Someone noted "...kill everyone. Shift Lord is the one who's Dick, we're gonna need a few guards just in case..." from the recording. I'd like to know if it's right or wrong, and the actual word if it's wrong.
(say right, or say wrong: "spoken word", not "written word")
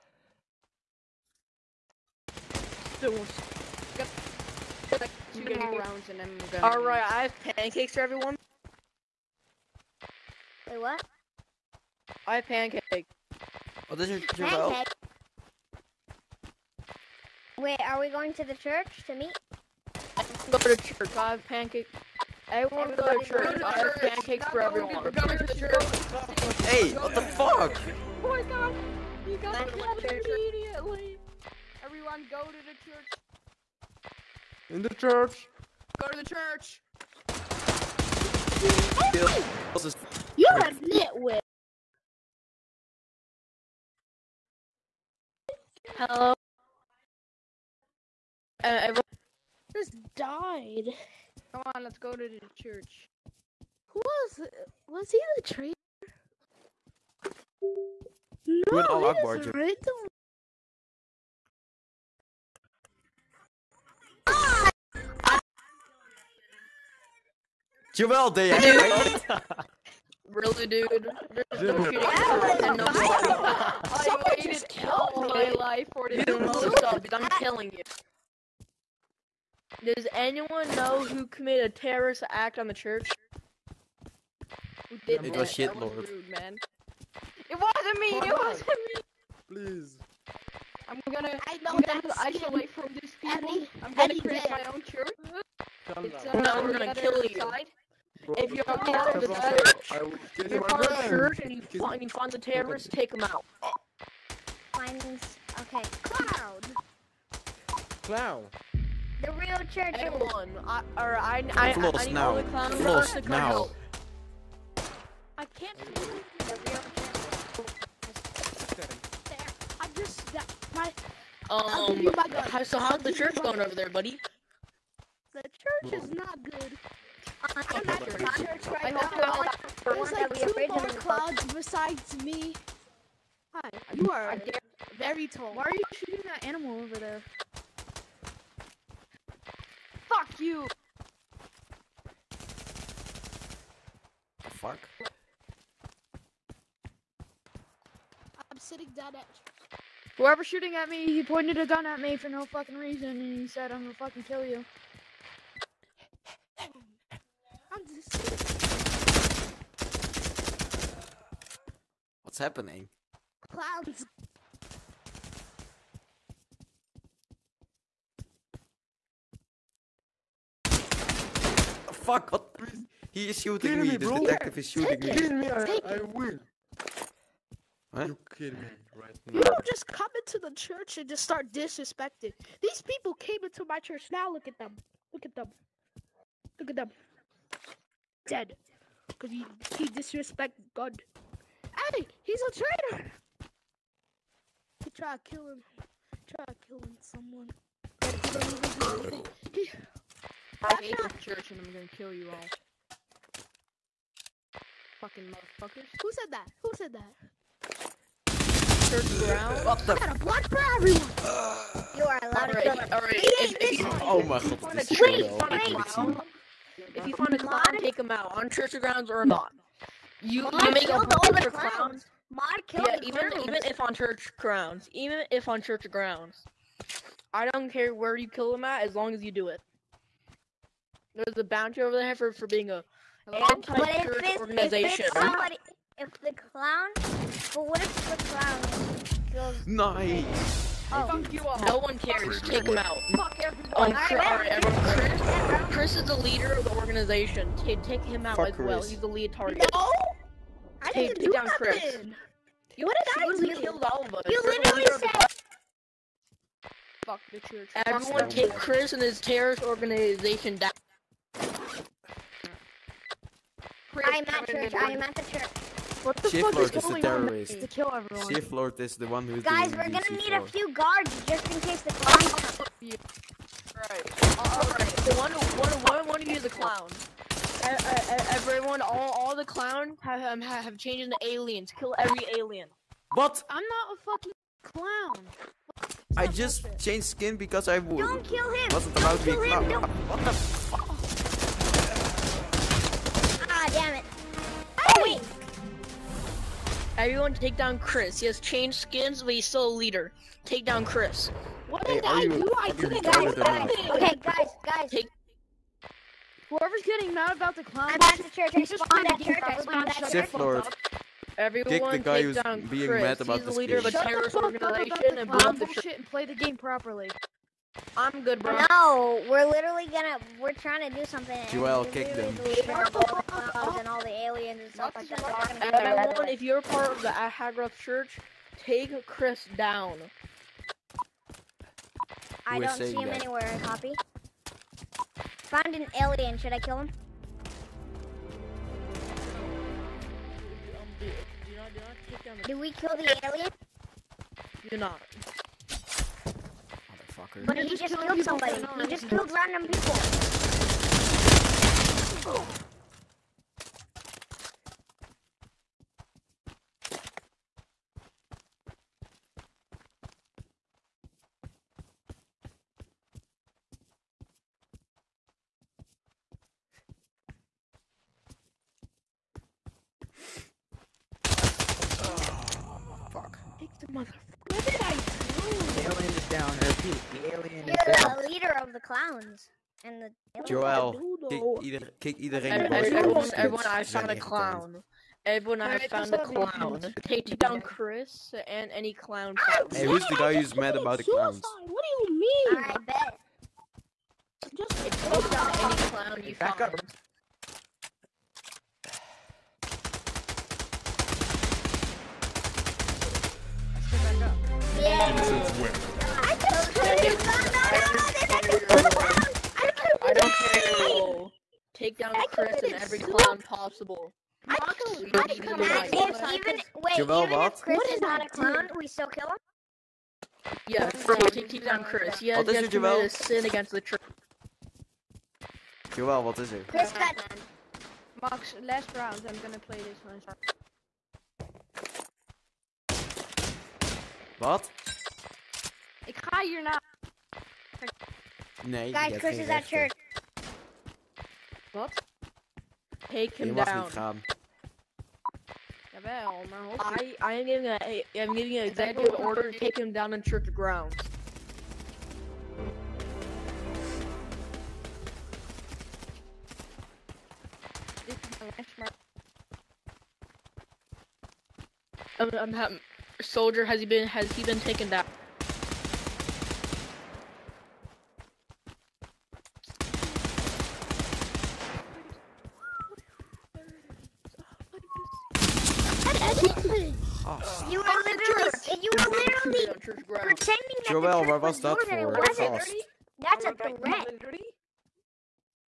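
wrong: "Guys", not "Dick".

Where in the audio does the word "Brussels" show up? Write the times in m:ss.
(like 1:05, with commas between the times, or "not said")
not said.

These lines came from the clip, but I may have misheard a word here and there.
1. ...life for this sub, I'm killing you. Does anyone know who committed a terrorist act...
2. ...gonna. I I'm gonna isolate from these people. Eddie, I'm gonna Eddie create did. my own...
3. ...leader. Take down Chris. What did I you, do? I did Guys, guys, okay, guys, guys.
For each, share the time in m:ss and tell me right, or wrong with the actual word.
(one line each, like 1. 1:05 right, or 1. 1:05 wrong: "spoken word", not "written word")
1. 1:15 right
2. 1:31 right
3. 4:59 right.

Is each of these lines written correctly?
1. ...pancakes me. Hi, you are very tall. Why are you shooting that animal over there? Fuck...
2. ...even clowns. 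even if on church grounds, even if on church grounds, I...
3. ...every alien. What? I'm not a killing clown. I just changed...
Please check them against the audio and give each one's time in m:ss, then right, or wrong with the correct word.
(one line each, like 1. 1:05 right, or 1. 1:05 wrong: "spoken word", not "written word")
1. 2:11 wrong: "besides", not "pancakes"
2. 3:43 right
3. 4:41 wrong: "fucking", not "killing".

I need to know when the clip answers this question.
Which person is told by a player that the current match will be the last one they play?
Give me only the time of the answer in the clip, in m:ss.
7:08.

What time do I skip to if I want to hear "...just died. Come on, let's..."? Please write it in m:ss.
0:49.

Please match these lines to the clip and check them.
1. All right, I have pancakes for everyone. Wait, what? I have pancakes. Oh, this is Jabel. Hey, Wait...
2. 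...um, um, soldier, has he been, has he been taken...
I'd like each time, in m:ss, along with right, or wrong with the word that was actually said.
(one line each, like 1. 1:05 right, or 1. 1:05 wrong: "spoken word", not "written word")
1. 0:06 right
2. 7:42 right.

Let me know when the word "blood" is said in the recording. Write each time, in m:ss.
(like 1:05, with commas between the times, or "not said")
3:30.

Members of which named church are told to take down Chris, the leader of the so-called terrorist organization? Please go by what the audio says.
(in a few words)
Ahagroth Church.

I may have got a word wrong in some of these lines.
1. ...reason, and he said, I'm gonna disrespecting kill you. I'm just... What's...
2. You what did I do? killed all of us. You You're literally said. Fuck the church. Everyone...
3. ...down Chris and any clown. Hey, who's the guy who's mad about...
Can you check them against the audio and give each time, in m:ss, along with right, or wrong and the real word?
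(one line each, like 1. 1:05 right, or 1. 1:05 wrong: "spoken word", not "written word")
1. 2:32 wrong: "fucking", not "disrespecting"
2. 4:12 right
3. 6:27 right.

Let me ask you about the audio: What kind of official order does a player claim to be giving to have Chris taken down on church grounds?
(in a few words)
executive order.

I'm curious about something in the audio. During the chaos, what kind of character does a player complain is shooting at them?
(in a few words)
detective.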